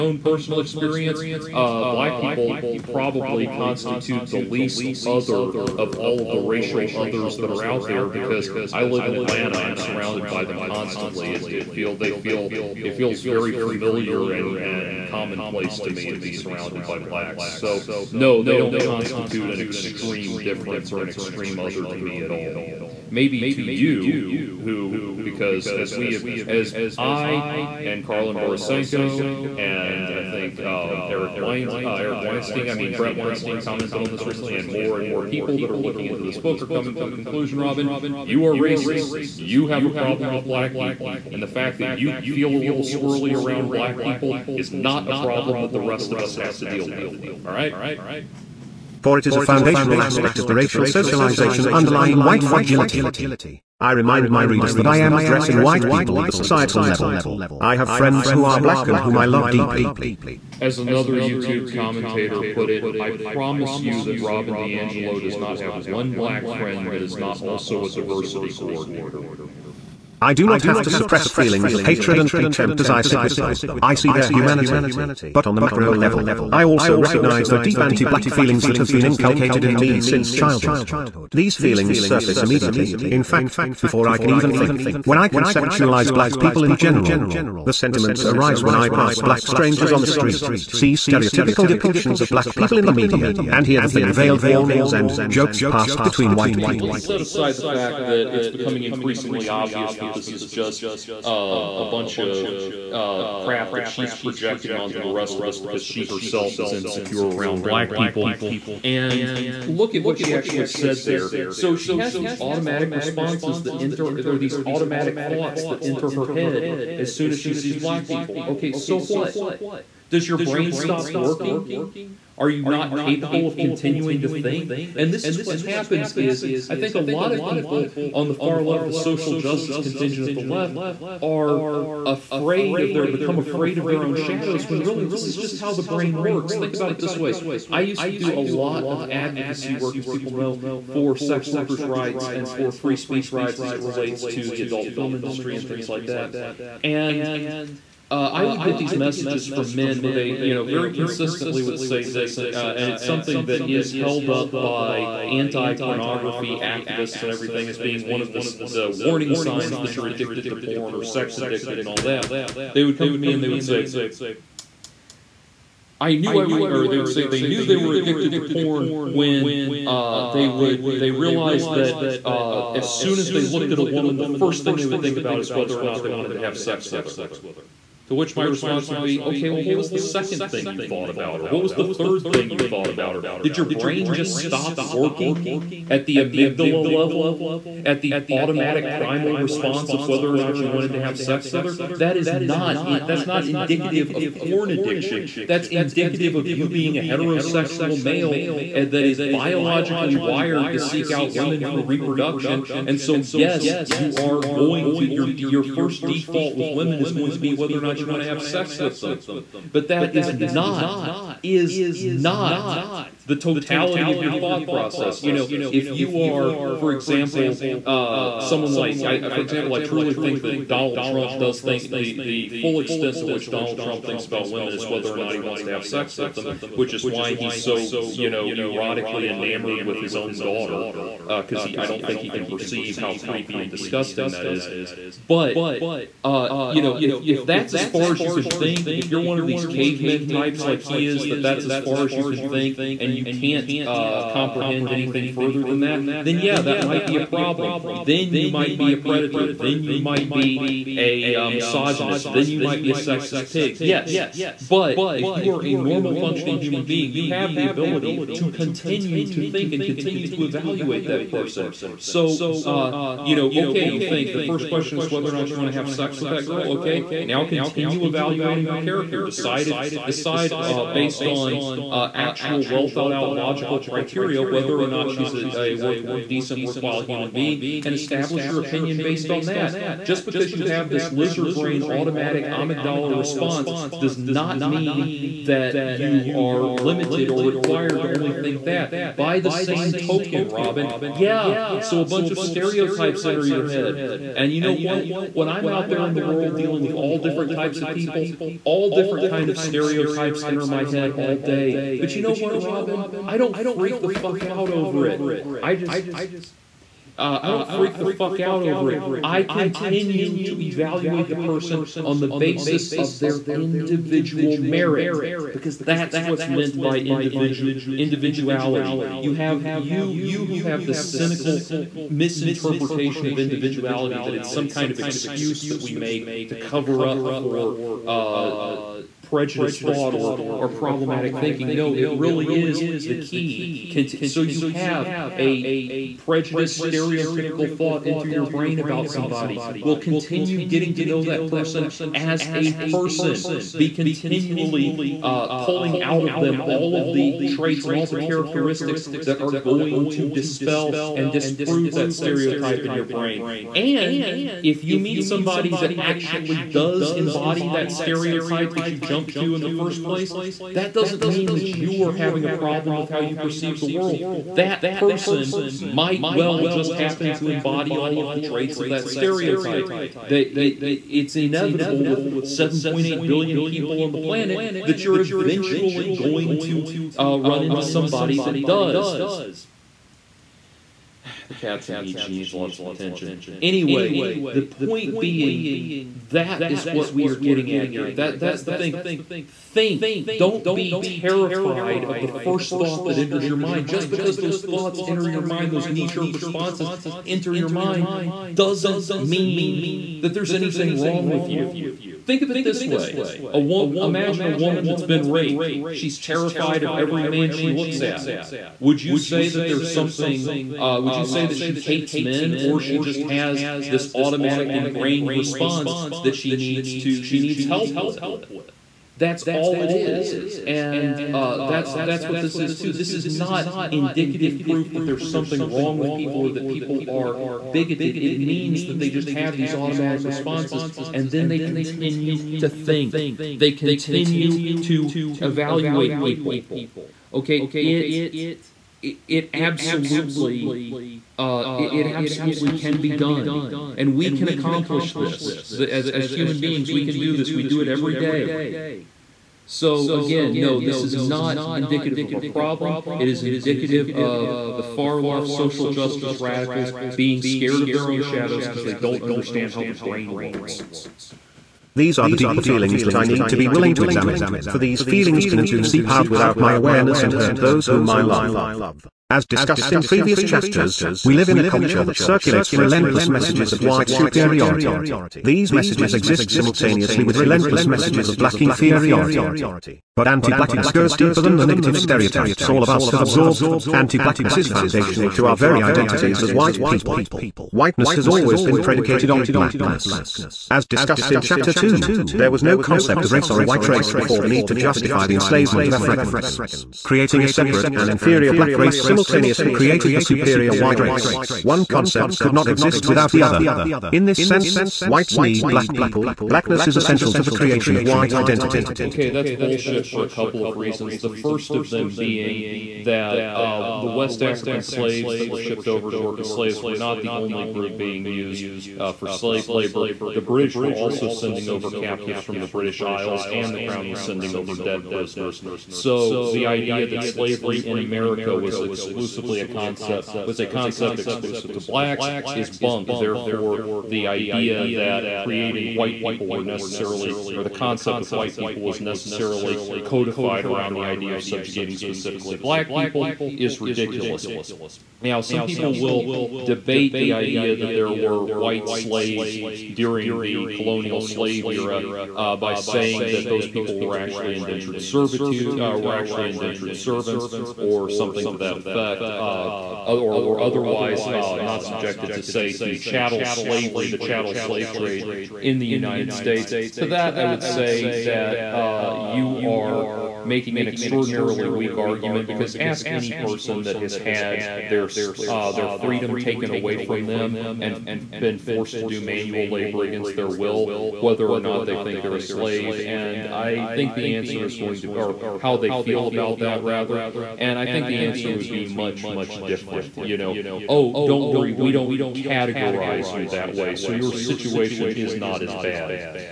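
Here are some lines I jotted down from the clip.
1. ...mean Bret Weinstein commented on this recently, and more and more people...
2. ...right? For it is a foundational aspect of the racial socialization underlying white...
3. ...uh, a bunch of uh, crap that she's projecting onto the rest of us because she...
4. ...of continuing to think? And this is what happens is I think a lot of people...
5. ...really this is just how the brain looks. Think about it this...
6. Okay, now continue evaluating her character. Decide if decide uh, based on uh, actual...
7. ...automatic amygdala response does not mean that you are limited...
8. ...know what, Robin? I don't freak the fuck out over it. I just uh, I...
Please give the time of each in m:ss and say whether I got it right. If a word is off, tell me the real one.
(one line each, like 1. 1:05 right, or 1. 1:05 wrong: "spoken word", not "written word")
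1. 0:32 right
2. 0:47 right
3. 1:41 right
4. 2:03 right
5. 2:14 wrong: "works", not "looks"
6. 4:26 right
7. 4:41 right
8. 5:02 right.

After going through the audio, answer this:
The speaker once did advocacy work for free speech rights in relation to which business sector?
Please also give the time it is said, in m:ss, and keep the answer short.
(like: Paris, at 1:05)
Adult film industry, at 2:24.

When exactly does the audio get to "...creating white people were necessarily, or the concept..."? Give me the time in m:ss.
8:55.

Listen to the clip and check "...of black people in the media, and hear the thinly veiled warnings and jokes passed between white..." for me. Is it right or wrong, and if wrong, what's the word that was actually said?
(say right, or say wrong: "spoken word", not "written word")
right.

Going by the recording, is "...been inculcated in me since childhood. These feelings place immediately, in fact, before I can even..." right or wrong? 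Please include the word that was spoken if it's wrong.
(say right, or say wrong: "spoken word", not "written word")
wrong: "surface", not "place".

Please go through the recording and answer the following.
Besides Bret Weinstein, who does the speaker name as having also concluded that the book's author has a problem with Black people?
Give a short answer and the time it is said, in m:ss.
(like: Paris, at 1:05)
Karlyn Borysenko, at 0:28.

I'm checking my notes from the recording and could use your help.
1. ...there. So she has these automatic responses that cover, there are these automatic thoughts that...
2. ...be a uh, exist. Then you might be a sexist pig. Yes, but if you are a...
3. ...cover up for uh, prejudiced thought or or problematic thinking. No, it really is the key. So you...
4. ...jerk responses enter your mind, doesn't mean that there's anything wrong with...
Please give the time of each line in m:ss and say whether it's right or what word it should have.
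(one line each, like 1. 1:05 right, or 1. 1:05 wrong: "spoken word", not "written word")
1. 1:51 wrong: "enter", not "cover"
2. 4:10 wrong: "misogynist", not "exist"
3. 5:26 right
4. 6:36 right.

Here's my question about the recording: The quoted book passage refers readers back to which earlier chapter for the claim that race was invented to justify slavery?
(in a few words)
Chapter 2.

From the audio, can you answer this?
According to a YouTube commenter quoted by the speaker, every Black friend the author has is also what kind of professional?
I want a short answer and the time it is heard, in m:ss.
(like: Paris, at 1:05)
Diversity coordinator, at 1:07.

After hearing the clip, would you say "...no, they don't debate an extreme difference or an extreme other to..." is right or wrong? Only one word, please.
wrong.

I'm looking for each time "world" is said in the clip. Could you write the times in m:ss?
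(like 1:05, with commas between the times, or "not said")
4:56, 6:03.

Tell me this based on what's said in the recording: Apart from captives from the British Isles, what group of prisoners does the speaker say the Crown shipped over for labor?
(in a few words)
Debt prisoners.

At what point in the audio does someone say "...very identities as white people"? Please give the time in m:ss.
8:05.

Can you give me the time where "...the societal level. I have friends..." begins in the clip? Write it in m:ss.
0:56.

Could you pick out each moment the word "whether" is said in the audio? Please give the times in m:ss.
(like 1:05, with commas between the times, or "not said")
2:55, 3:10, 3:27, 3:44, 4:25, 4:34, 9:41.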